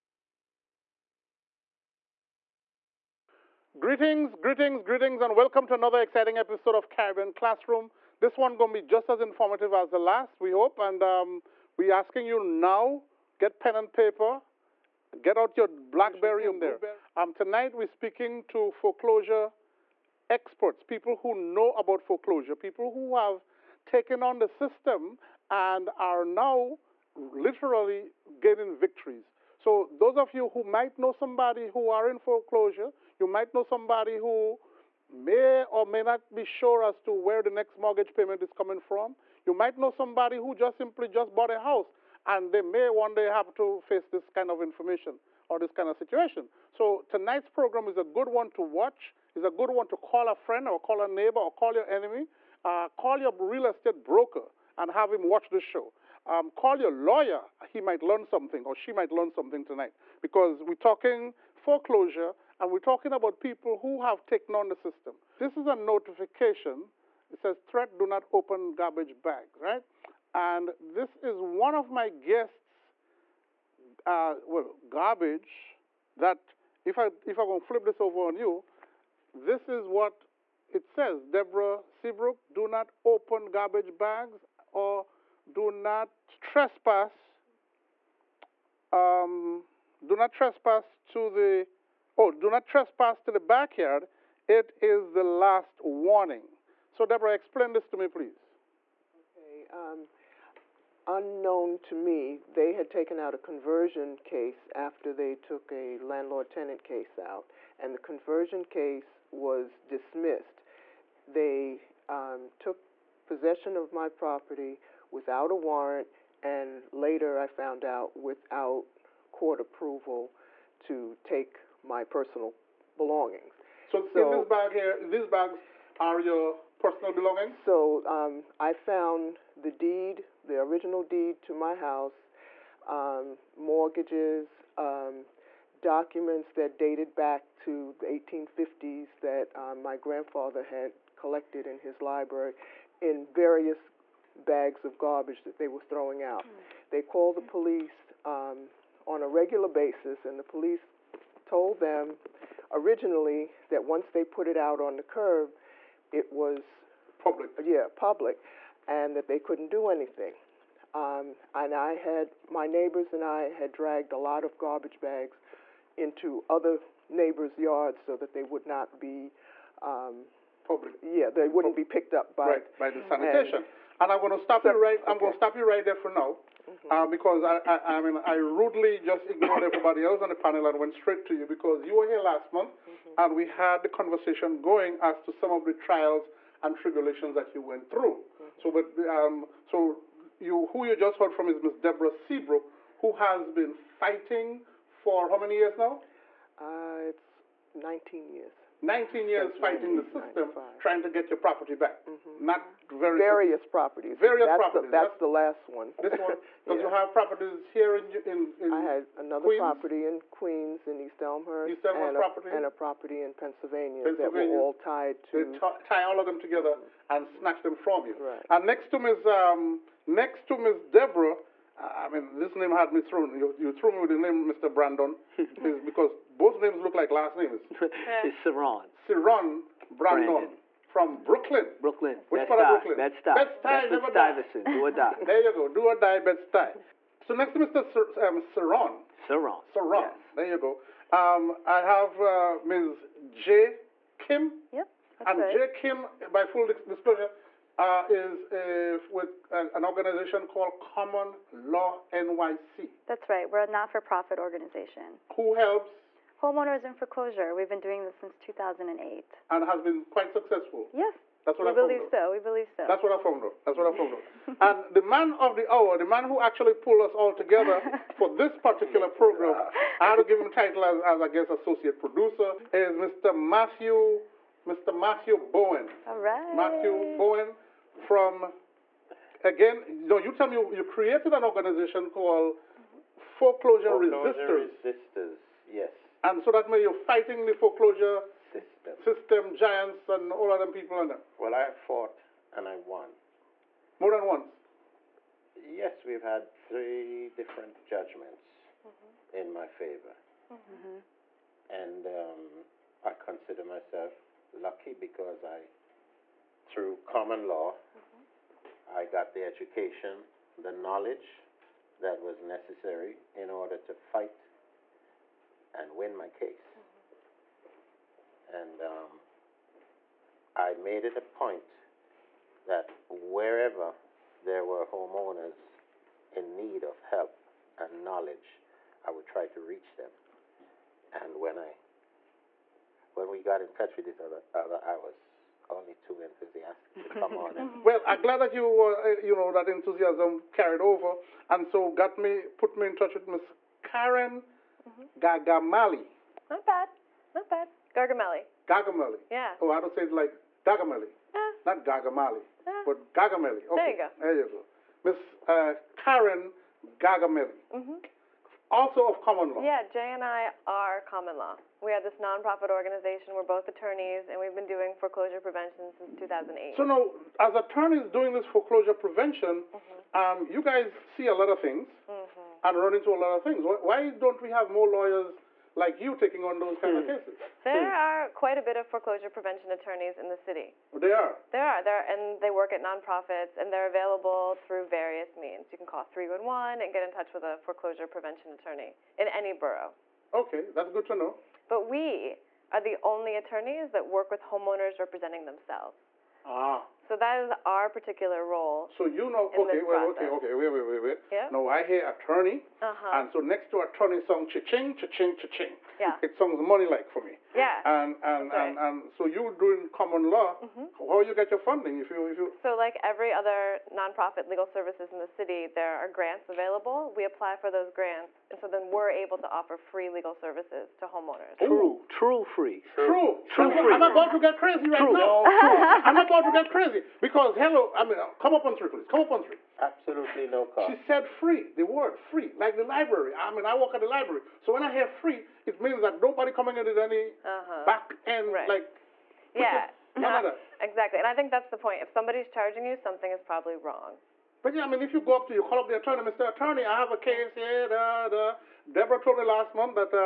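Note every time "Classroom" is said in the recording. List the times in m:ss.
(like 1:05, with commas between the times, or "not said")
0:07.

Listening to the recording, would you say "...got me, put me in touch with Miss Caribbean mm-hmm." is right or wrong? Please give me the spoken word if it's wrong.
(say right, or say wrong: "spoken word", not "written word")
wrong: "Karen", not "Caribbean".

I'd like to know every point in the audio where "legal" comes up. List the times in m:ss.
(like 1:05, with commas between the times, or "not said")
6:54, 7:00.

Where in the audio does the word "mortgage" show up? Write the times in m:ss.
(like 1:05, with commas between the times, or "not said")
0:37, 2:13.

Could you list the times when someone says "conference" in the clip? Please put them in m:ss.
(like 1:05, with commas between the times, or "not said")
not said.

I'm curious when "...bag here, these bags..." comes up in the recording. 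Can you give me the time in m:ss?
2:04.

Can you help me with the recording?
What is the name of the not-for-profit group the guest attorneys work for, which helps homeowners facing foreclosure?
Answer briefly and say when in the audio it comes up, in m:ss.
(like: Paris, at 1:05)
Common Law NYC, at 4:10.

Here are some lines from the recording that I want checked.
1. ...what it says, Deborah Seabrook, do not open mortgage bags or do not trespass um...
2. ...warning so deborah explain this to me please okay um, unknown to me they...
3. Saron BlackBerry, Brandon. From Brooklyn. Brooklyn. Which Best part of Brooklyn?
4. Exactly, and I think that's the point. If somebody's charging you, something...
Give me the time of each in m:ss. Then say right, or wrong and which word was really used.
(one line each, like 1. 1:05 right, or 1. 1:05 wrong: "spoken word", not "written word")
1. 1:19 wrong: "garbage", not "mortgage"
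2. 1:35 right
3. 3:48 wrong: "Brandon", not "BlackBerry"
4. 7:20 right.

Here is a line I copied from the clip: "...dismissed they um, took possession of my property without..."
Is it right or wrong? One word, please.
right.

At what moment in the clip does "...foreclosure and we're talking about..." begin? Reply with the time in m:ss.
1:01.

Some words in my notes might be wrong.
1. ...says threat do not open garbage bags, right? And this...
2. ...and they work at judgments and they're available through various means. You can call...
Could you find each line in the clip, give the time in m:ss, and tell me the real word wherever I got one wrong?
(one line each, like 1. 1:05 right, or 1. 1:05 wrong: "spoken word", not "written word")
1. 1:07 right
2. 6:22 wrong: "nonprofits", not "judgments".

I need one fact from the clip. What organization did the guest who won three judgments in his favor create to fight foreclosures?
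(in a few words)
Foreclosure Resisters.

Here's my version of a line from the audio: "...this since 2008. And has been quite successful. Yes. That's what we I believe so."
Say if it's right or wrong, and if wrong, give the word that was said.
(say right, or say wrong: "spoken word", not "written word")
right.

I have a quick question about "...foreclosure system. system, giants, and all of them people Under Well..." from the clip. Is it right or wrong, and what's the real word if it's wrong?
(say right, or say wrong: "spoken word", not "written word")
right.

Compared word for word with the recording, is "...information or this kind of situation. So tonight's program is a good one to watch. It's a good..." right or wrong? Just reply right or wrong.
right.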